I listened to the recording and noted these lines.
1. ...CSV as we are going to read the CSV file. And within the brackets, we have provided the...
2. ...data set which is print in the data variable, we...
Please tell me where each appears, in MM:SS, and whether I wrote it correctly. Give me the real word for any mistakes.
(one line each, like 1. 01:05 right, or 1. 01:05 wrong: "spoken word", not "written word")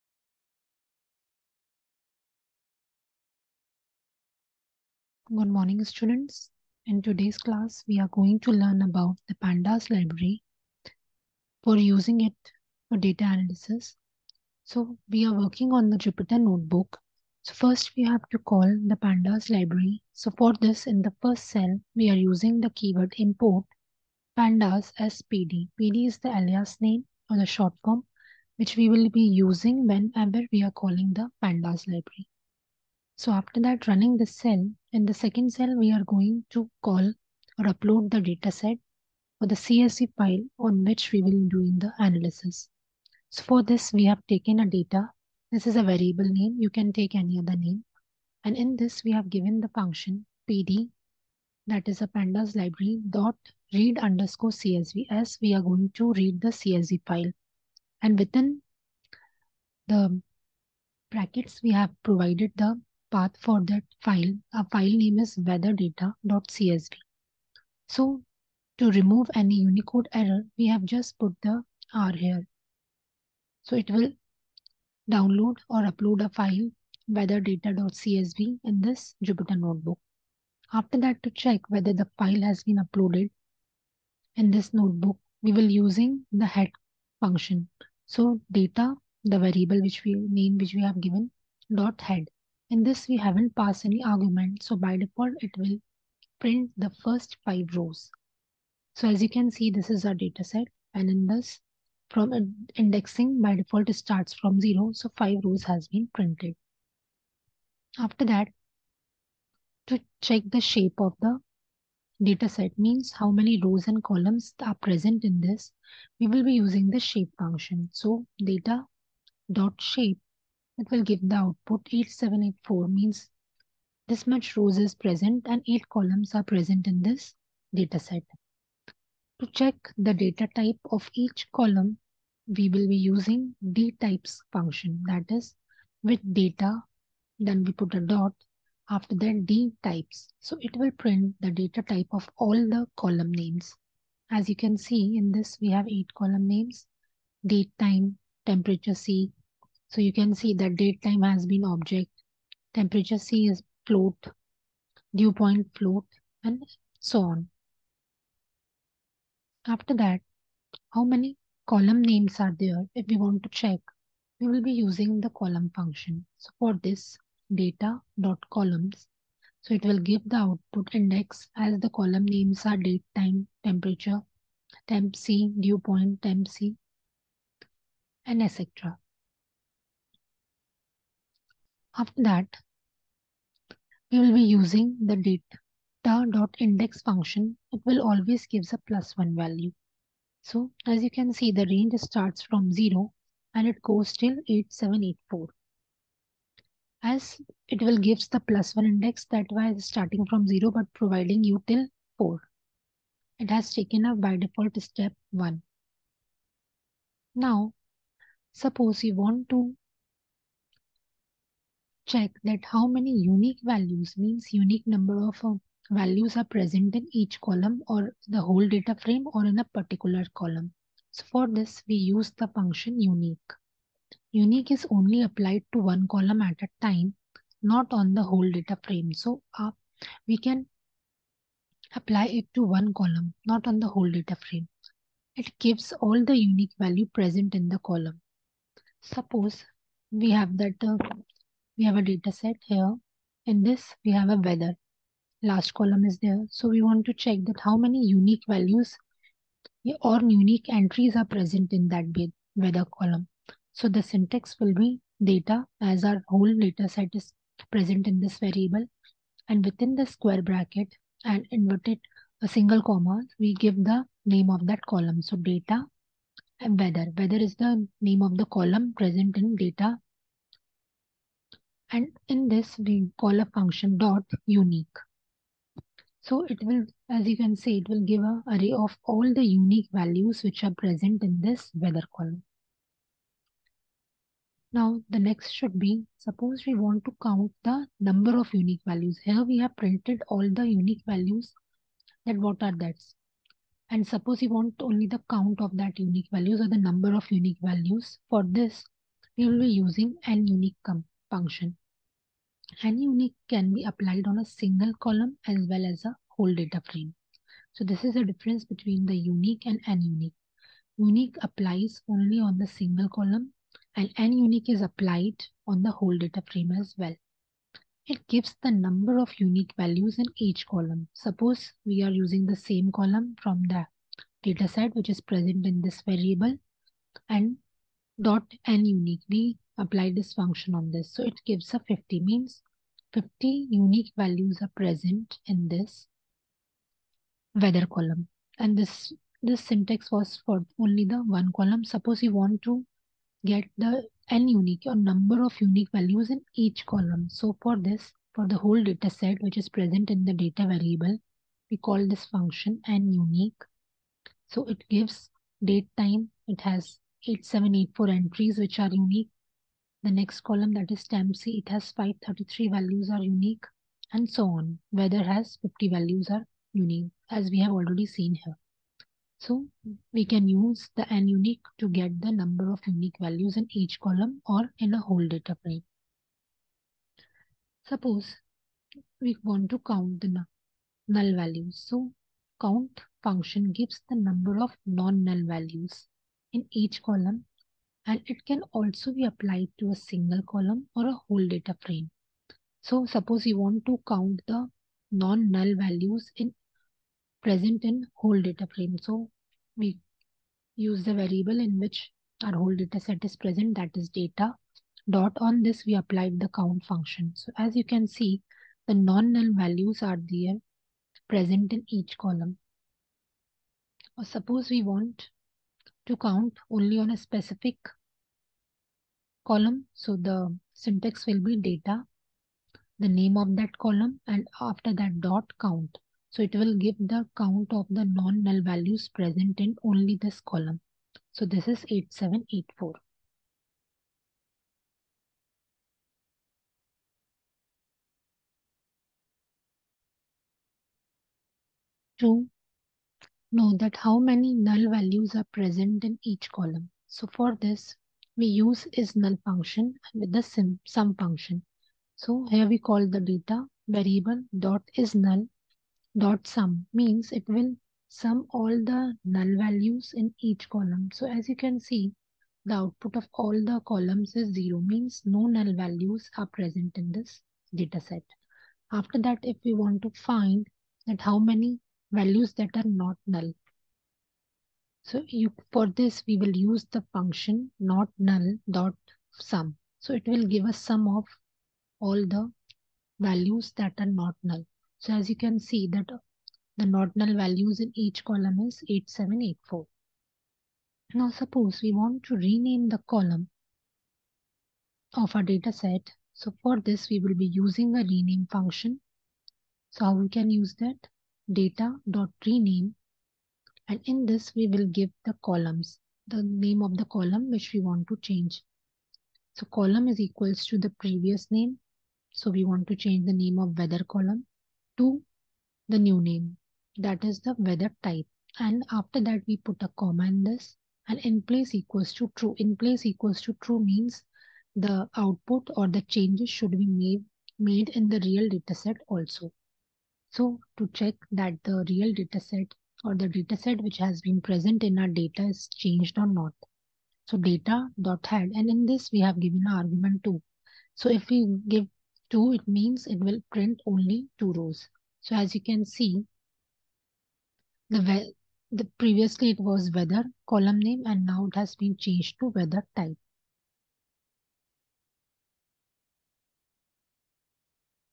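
1. 00:54 right
2. 05:48 wrong: "present", not "print".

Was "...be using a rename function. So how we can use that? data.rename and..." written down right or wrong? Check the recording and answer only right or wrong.
right.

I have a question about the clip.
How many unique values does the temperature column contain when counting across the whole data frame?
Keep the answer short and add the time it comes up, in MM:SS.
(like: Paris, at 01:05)
533, at 06:01.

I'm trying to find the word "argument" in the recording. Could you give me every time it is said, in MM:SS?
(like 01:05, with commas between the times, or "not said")
01:34, 08:59.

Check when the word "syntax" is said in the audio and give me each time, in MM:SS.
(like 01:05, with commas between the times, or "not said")
04:14, 05:39, 07:00.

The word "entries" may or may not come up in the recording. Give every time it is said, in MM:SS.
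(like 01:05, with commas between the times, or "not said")
04:10, 05:58.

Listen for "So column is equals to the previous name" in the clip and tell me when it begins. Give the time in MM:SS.
08:29.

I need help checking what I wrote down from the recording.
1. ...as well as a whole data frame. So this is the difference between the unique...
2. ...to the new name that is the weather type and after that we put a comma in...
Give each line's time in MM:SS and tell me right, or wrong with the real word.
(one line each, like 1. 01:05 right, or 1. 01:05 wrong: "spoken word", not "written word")
1. 05:05 right
2. 08:34 right.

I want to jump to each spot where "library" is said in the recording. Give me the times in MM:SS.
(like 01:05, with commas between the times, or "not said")
00:09, 00:19, 00:31, 00:52.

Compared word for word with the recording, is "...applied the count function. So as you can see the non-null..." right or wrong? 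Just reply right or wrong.
right.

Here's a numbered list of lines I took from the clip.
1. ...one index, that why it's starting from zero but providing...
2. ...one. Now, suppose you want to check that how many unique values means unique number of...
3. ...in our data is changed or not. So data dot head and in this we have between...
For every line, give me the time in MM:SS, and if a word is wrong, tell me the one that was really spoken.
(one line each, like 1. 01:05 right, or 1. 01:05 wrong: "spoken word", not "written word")
1. 03:18 right
2. 03:25 right
3. 08:54 wrong: "given", not "between".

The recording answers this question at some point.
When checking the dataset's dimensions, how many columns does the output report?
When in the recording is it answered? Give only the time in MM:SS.
02:05.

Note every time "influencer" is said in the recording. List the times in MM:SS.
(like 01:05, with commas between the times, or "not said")
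not said.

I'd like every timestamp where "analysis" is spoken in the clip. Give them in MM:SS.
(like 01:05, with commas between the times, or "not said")
00:13, 00:41.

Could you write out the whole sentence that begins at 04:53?
And suppose you want only the count of that unique values or the number of unique values.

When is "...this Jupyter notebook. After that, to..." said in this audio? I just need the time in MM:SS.
01:18.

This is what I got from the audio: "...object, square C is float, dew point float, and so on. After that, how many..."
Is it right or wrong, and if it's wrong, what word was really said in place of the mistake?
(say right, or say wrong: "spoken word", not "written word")
wrong: "temperature", not "square".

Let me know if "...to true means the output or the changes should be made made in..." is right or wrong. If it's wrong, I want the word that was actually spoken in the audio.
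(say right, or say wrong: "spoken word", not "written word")
right.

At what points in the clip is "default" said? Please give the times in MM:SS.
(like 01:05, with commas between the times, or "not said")
01:34, 01:43, 03:24.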